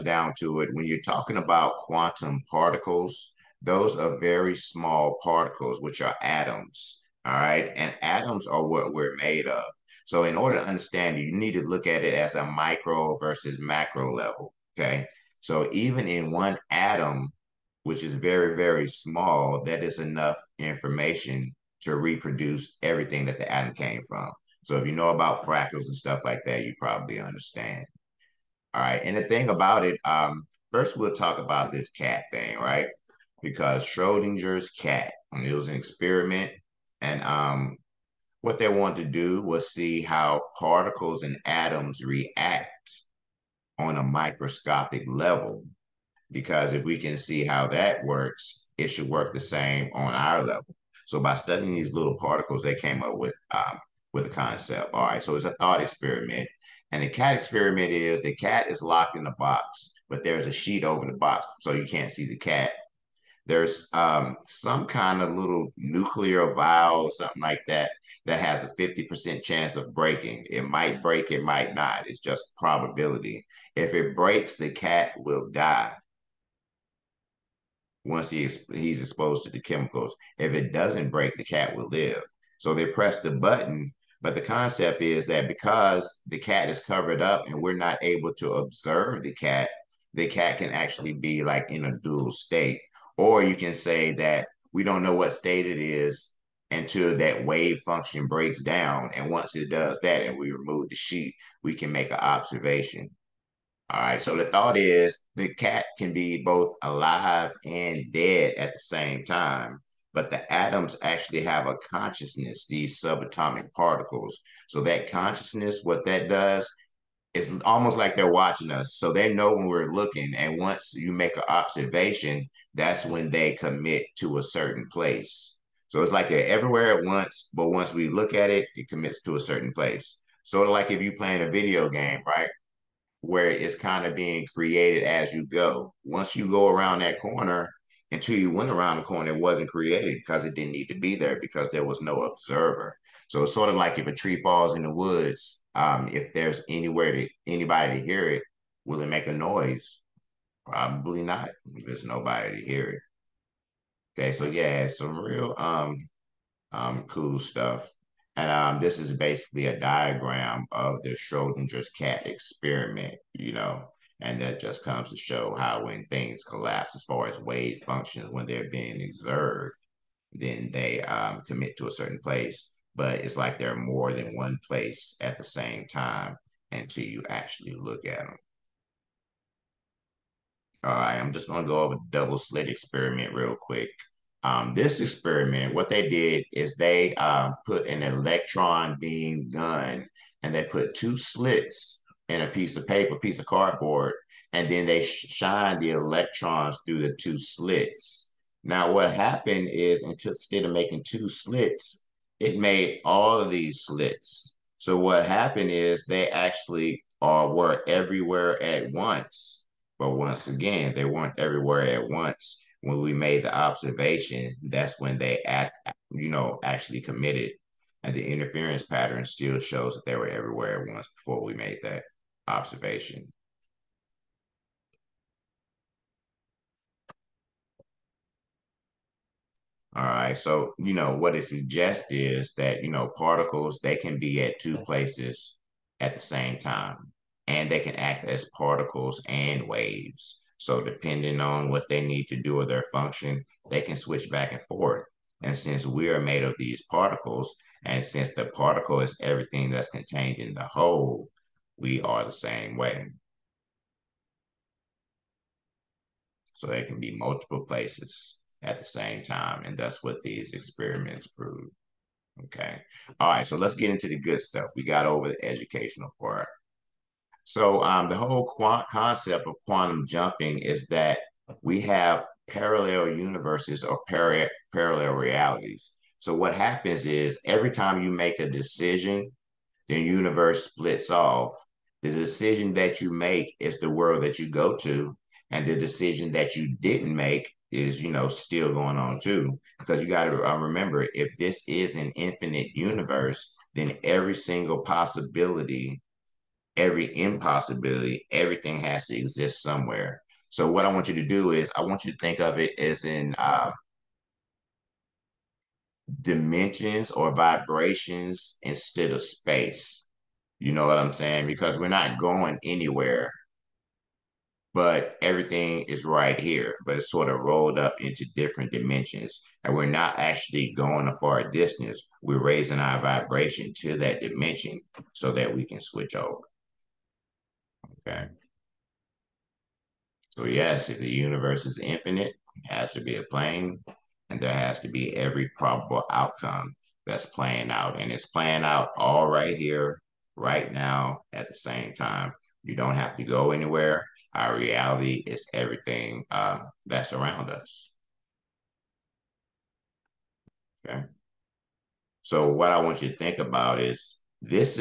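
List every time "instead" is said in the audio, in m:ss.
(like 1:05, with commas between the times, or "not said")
3:20, 5:08.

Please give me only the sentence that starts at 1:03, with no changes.
There's um, some kind of little nuclear vial, something like that, that has a 50% chance of breaking.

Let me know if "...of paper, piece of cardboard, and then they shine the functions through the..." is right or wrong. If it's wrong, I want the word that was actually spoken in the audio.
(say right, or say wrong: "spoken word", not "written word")
wrong: "electrons", not "functions".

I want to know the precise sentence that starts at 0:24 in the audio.
So if you know about fractals and stuff like that, you probably understand.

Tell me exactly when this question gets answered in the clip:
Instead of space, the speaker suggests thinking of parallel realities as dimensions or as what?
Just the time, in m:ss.
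5:07.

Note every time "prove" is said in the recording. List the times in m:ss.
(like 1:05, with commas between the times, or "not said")
4:21.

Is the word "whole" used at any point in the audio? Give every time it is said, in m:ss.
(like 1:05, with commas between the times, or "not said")
4:10, 4:28.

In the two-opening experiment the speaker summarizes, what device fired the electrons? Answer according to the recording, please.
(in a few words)
Electron beam gun.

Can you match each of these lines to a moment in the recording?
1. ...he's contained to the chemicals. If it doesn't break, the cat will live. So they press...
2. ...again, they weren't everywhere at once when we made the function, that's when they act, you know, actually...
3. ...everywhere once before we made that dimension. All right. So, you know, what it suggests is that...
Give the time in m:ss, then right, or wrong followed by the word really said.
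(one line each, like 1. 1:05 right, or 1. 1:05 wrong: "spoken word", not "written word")
1. 1:18 wrong: "exposed", not "contained"
2. 3:30 wrong: "observation", not "function"
3. 3:40 wrong: "observation", not "dimension".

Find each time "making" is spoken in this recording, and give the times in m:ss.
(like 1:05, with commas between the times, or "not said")
3:20.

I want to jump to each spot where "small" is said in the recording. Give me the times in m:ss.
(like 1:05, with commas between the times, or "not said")
0:04, 0:18.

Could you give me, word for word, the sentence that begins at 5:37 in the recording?
And it's playing out all right here, right now, at the same time.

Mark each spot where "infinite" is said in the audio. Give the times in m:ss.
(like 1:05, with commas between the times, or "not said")
4:52, 5:31.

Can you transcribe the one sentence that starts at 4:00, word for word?
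So depending on what they need to do or their function, they can switch back and forth.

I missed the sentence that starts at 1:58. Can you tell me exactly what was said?
So they know when we're looking.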